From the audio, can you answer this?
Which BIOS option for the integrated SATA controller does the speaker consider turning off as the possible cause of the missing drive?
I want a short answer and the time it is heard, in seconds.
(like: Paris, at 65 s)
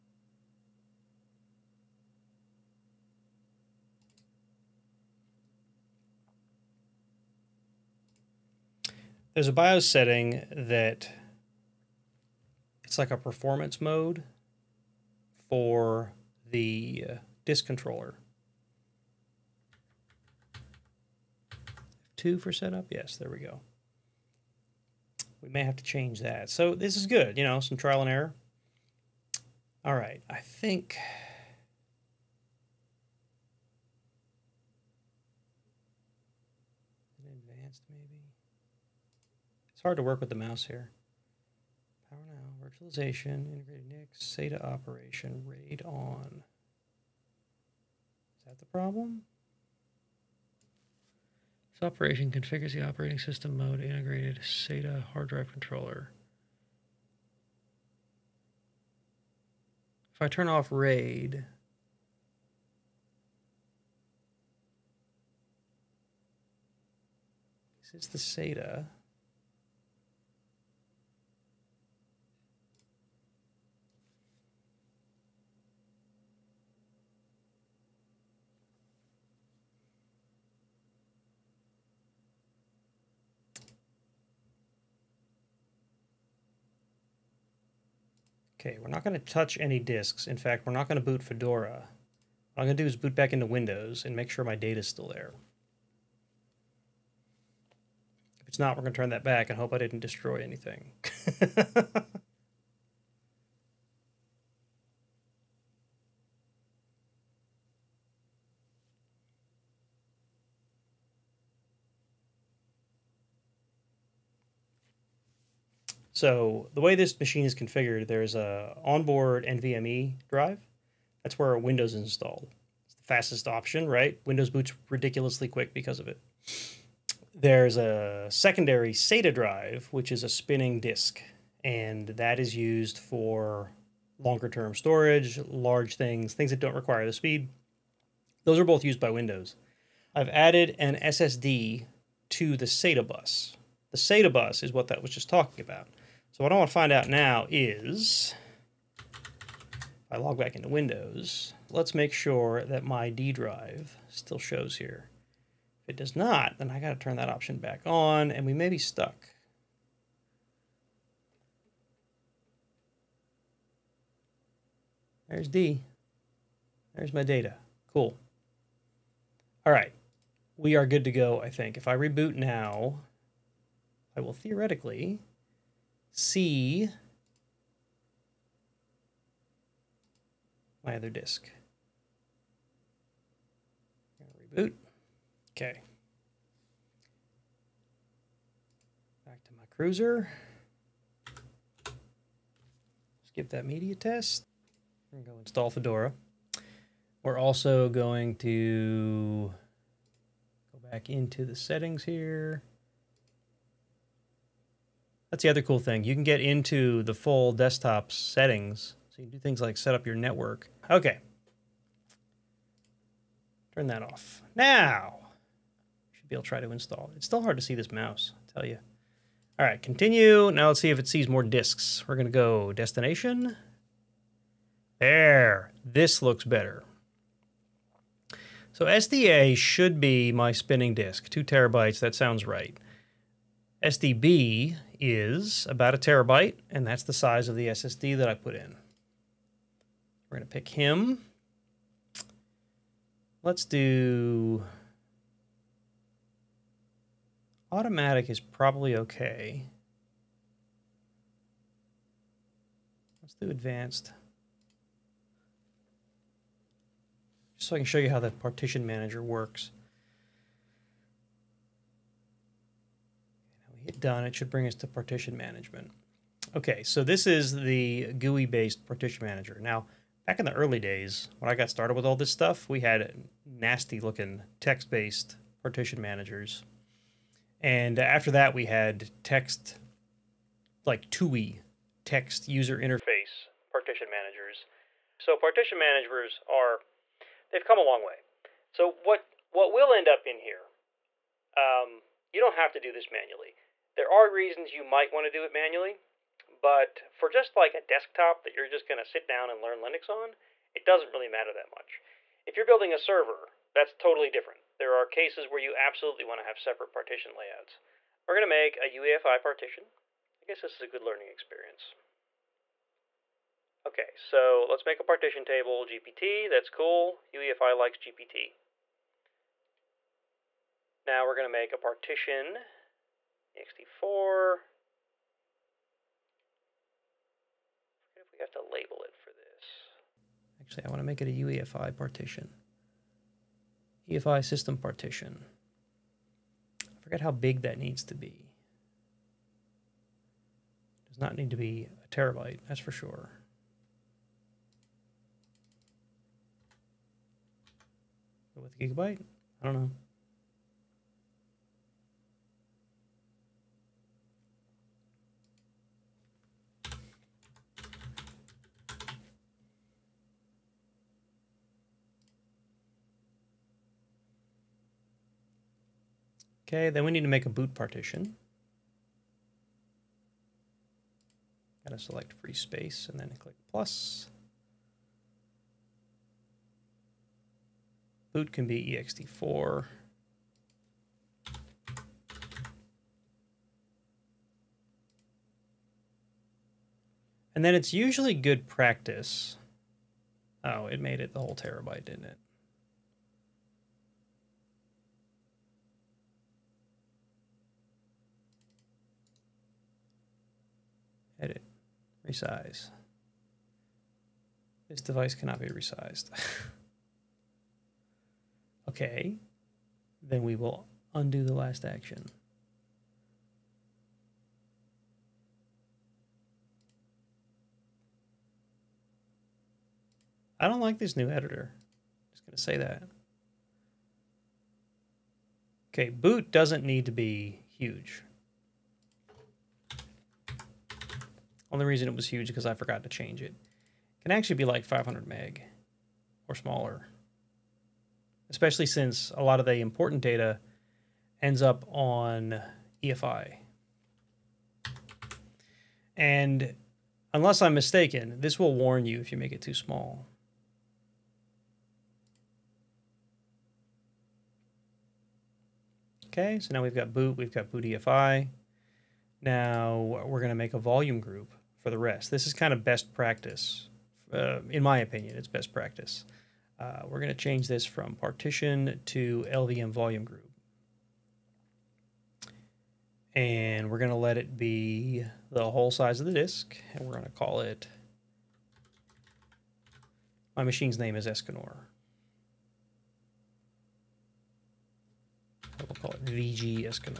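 RAID on, at 45 s.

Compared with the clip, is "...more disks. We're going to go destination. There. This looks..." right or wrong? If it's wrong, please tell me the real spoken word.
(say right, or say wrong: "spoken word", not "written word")
right.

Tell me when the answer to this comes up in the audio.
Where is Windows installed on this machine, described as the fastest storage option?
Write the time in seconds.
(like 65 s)
118 s.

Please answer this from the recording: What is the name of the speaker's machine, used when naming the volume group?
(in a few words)
Escanor.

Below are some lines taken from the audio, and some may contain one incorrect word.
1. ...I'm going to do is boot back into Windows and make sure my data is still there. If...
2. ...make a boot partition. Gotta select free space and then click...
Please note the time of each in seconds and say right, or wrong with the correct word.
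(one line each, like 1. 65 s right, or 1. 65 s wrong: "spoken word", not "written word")
1. 92 s right
2. 367 s right.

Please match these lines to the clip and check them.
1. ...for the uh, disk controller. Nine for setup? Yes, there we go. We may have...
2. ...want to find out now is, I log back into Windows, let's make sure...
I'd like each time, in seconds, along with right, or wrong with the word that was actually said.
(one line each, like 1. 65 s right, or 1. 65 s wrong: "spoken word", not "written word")
1. 15 s wrong: "Two", not "Nine"
2. 146 s right.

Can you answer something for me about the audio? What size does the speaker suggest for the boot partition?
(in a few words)
500 meg.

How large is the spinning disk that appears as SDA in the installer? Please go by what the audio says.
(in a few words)
2 terabytes.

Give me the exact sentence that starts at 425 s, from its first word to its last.
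Okay, boot doesn't need to be huge.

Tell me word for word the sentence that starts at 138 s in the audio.
Those are both used by Windows.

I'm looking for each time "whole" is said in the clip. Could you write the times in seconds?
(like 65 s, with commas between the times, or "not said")
391 s, 475 s.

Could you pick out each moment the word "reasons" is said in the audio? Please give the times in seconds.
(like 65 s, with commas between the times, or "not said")
294 s, 431 s.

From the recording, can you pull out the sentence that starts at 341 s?
Does not need to be a terabyte, that's for sure.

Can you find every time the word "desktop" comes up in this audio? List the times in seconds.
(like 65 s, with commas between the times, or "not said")
207 s, 297 s.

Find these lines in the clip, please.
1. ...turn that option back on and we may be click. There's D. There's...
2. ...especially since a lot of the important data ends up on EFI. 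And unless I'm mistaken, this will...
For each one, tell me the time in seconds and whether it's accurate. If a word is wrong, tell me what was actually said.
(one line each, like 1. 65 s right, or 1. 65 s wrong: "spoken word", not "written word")
1. 156 s wrong: "stuck", not "click"
2. 438 s right.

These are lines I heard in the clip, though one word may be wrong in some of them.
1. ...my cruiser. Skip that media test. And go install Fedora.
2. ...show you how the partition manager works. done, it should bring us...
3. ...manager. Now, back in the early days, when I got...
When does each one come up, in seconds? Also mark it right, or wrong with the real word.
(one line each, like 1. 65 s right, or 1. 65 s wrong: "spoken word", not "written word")
1. 189 s right
2. 257 s right
3. 269 s right.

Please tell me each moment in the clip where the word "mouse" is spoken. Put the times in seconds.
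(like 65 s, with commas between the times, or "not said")
40 s, 217 s.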